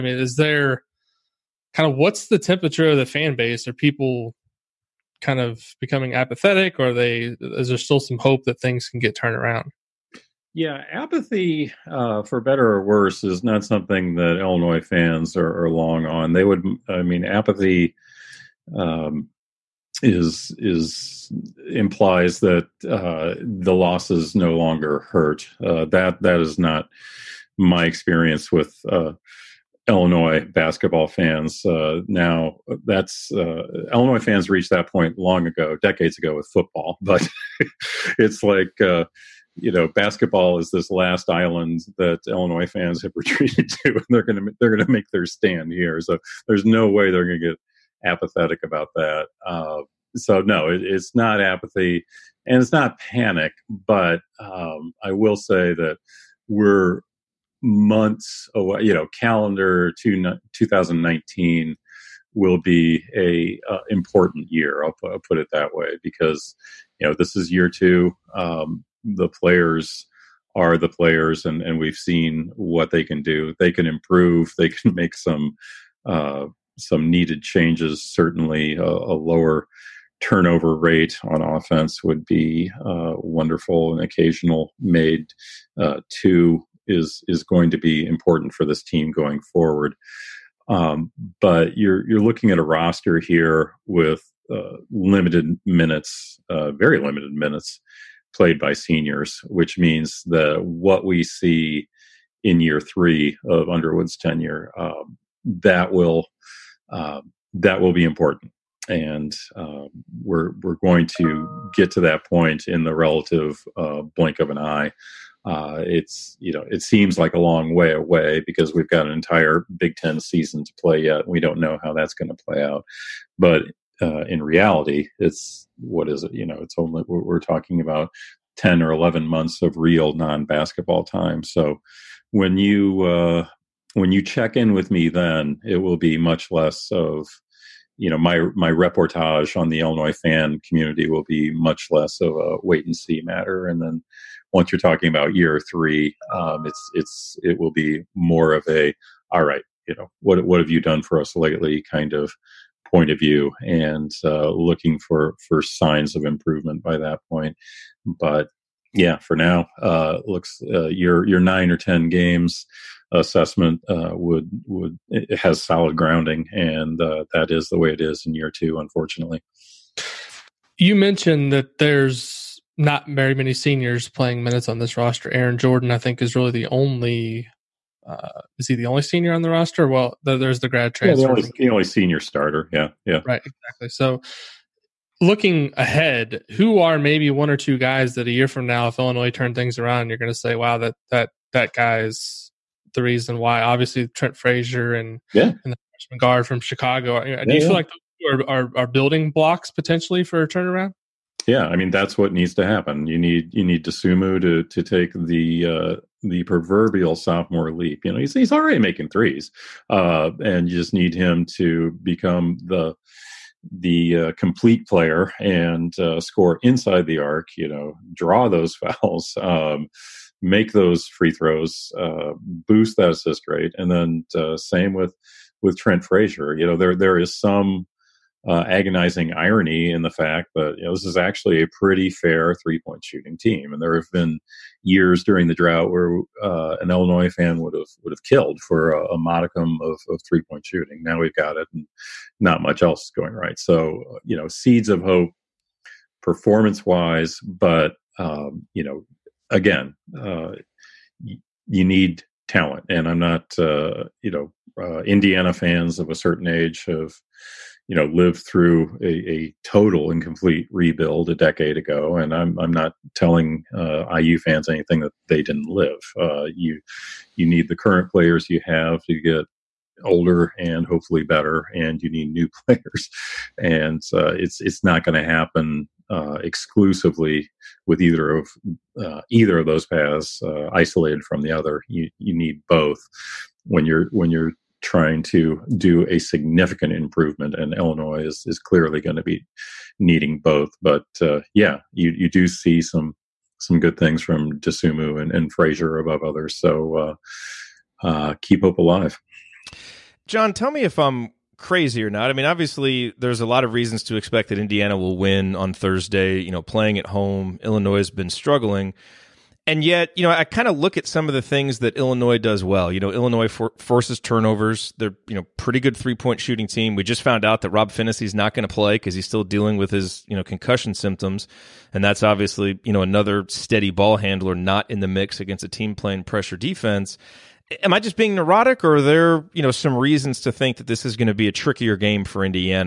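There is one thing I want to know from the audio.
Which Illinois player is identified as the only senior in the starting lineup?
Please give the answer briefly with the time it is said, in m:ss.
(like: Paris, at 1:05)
Aaron Jordan, at 2:55.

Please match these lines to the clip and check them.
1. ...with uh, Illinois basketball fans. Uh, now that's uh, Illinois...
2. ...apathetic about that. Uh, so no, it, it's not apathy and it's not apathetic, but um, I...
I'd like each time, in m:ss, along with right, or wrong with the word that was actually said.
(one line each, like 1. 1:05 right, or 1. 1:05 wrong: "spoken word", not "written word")
1. 0:28 right
2. 0:48 wrong: "panic", not "apathetic".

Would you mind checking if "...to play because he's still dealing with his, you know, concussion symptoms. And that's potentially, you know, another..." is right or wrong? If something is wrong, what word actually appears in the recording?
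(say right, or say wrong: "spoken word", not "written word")
wrong: "obviously", not "potentially".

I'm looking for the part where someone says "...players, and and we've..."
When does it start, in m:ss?
1:10.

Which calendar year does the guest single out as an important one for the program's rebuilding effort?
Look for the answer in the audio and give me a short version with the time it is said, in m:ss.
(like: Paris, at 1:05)
2019, at 1:00.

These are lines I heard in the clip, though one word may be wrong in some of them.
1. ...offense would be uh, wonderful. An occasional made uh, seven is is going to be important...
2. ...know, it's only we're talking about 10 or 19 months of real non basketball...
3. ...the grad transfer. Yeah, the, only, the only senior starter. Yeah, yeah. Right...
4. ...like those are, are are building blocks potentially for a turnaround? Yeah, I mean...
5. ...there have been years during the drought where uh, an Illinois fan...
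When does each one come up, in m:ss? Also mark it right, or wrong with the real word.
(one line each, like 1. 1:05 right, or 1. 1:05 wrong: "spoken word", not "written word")
1. 1:21 wrong: "two", not "seven"
2. 2:06 wrong: "11", not "19"
3. 3:00 right
4. 3:17 right
5. 3:53 right.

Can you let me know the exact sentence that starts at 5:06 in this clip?
You know, playing at home, Illinois has been struggling.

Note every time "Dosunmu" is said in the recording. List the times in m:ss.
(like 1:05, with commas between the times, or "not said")
3:23, 4:54.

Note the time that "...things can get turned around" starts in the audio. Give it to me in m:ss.
0:08.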